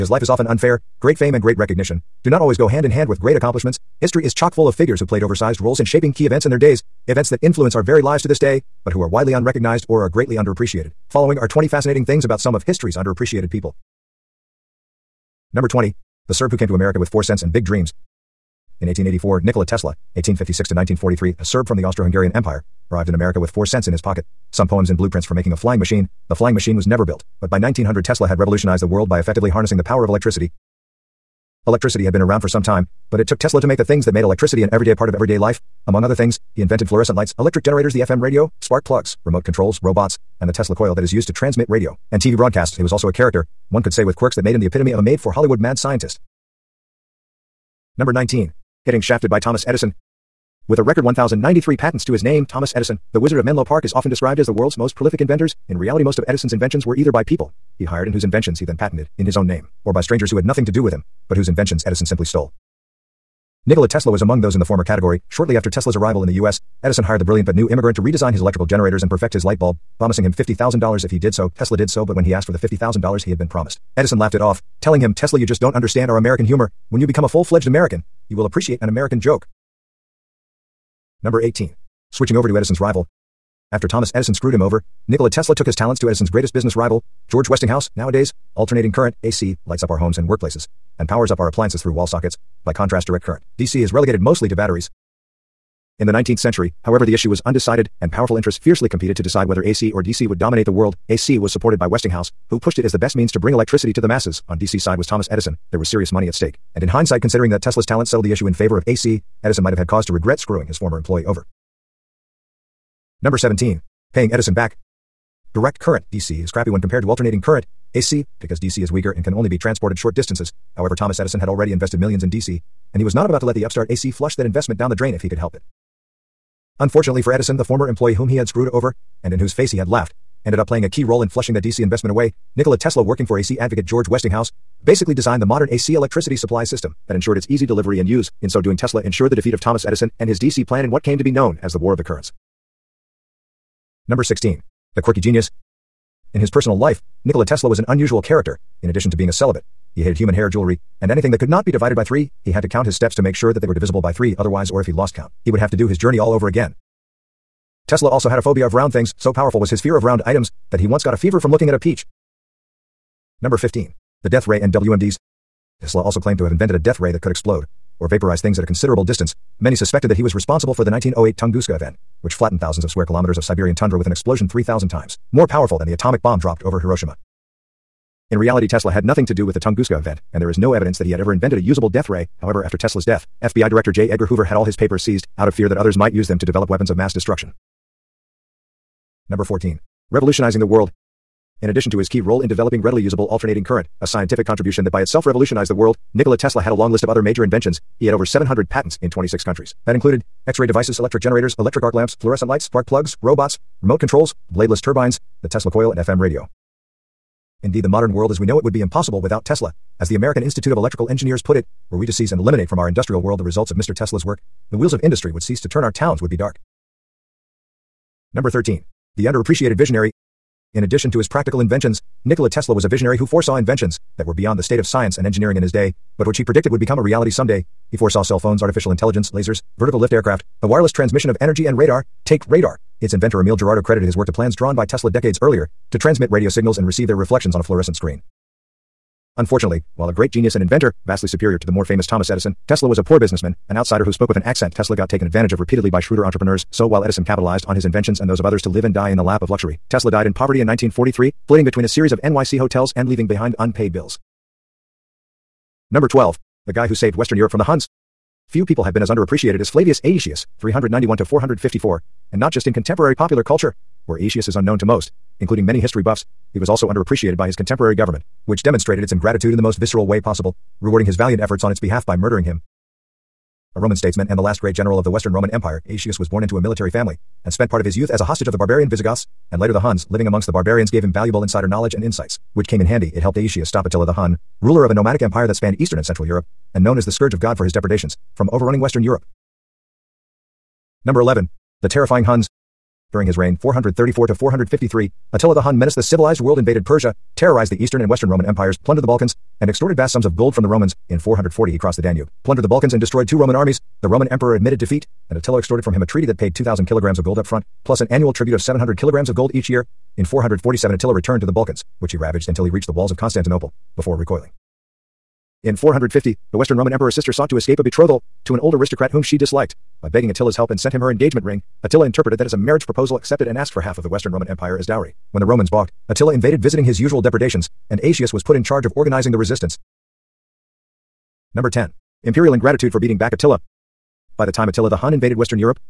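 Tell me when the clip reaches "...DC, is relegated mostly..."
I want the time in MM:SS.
01:33.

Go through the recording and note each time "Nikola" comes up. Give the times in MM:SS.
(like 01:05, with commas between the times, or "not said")
00:19, 01:03, 01:25, 02:12, 02:27, 03:16, 03:42.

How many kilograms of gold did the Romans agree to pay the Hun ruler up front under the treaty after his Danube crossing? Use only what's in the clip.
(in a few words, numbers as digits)
2,000 kilograms.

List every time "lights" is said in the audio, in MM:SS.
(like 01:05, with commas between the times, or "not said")
00:37, 01:09, 01:29, 03:22.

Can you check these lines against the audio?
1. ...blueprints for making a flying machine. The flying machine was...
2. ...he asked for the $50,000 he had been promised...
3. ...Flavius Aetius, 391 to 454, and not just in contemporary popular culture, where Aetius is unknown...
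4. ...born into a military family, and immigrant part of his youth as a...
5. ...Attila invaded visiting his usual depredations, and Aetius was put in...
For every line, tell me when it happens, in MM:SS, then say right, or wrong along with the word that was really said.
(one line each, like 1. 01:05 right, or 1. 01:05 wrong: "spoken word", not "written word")
1. 00:24 right
2. 01:12 right
3. 04:19 right
4. 04:36 wrong: "spent", not "immigrant"
5. 05:26 right.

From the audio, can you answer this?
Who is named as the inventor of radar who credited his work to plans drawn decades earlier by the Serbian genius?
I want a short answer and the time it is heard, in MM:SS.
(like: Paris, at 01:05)
Emile Girardeau, at 03:53.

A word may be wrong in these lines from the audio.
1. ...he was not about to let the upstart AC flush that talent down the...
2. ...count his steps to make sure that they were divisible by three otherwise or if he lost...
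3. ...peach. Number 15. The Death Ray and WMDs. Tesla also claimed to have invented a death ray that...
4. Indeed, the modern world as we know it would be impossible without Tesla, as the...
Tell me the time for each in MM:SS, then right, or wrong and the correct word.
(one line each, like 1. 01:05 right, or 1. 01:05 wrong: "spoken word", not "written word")
1. 02:02 wrong: "investment", not "talent"
2. 02:32 right
3. 02:41 right
4. 03:27 right.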